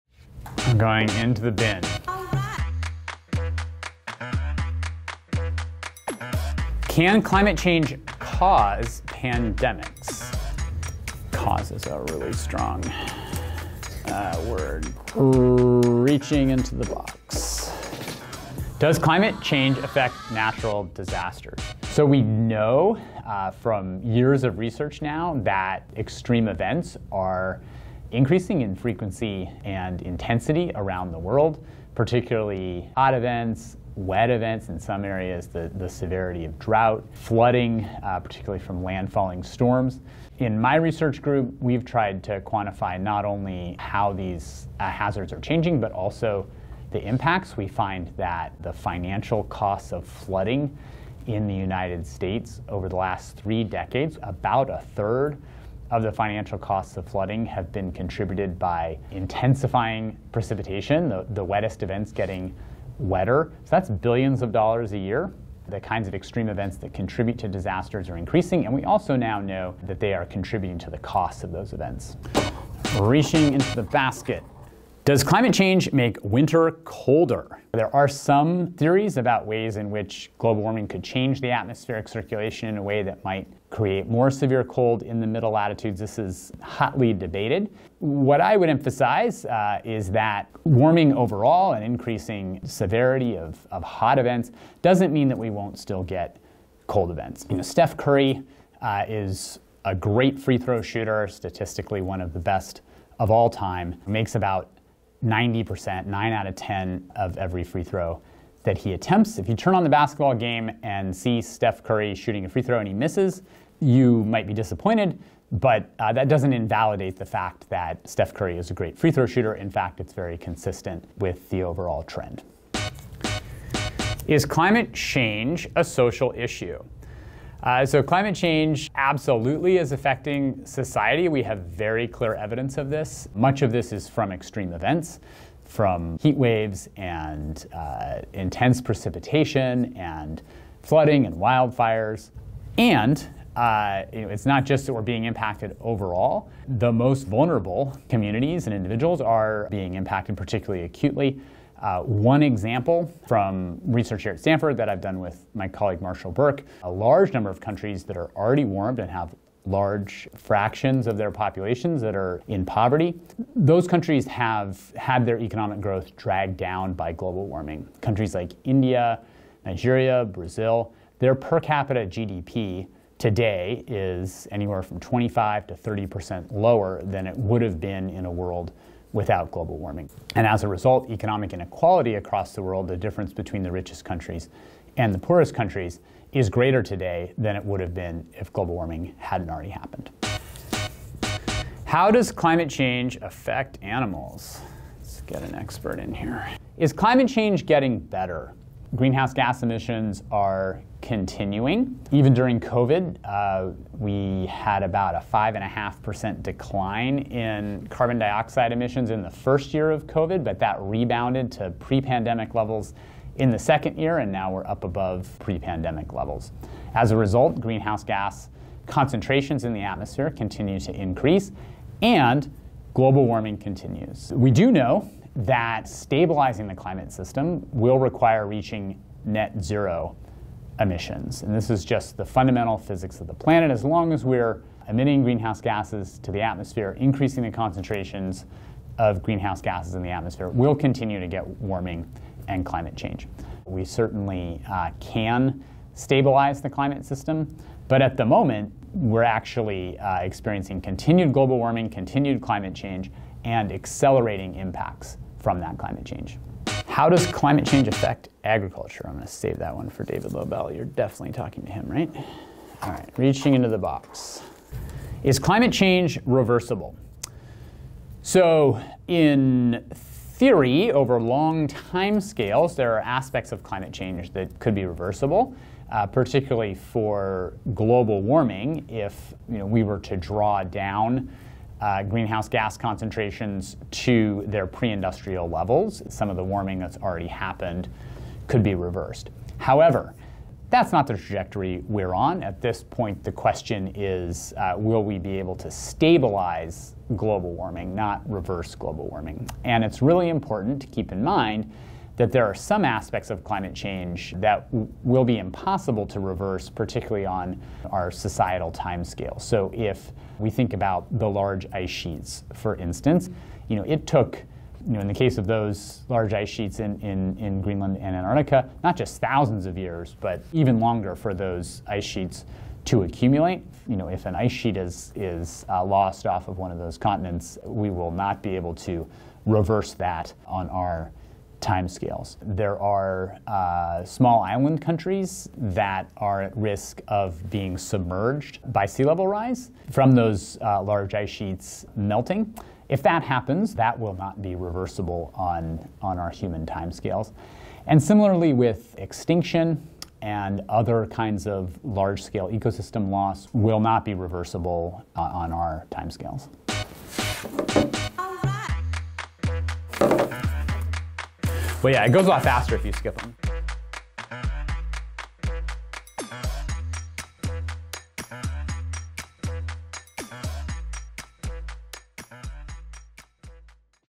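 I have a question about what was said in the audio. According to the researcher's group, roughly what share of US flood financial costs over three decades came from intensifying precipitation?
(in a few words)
a third.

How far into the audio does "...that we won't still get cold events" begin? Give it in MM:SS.
01:35.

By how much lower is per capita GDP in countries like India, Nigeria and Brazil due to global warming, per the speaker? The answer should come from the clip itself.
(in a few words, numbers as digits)
25 to 30 percent.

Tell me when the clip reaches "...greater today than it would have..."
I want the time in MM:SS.
03:06.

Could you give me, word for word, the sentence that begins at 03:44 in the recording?
We do know that stabilizing the climate system will require reaching net zero emissions.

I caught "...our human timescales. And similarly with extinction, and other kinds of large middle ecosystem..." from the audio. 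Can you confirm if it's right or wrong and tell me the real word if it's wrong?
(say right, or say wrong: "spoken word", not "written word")
wrong: "scale", not "middle".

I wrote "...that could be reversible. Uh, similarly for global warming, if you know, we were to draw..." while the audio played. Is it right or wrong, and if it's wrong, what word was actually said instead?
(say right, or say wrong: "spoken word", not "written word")
wrong: "particularly", not "similarly".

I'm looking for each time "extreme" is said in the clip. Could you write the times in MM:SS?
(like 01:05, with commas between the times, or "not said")
00:25, 01:06, 02:14.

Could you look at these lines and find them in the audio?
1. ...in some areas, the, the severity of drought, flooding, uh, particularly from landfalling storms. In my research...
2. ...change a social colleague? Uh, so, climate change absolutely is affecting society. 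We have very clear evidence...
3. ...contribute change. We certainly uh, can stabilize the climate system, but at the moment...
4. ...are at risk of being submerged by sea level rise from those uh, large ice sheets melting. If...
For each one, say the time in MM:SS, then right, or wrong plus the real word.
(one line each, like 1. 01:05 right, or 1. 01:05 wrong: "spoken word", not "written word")
1. 00:34 right
2. 02:04 wrong: "issue", not "colleague"
3. 04:02 wrong: "climate", not "contribute"
4. 05:36 right.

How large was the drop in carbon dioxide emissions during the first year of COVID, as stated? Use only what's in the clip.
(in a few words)
5.5%.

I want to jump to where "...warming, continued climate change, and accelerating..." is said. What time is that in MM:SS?
04:11.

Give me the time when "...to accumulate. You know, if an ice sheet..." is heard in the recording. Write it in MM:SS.
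05:22.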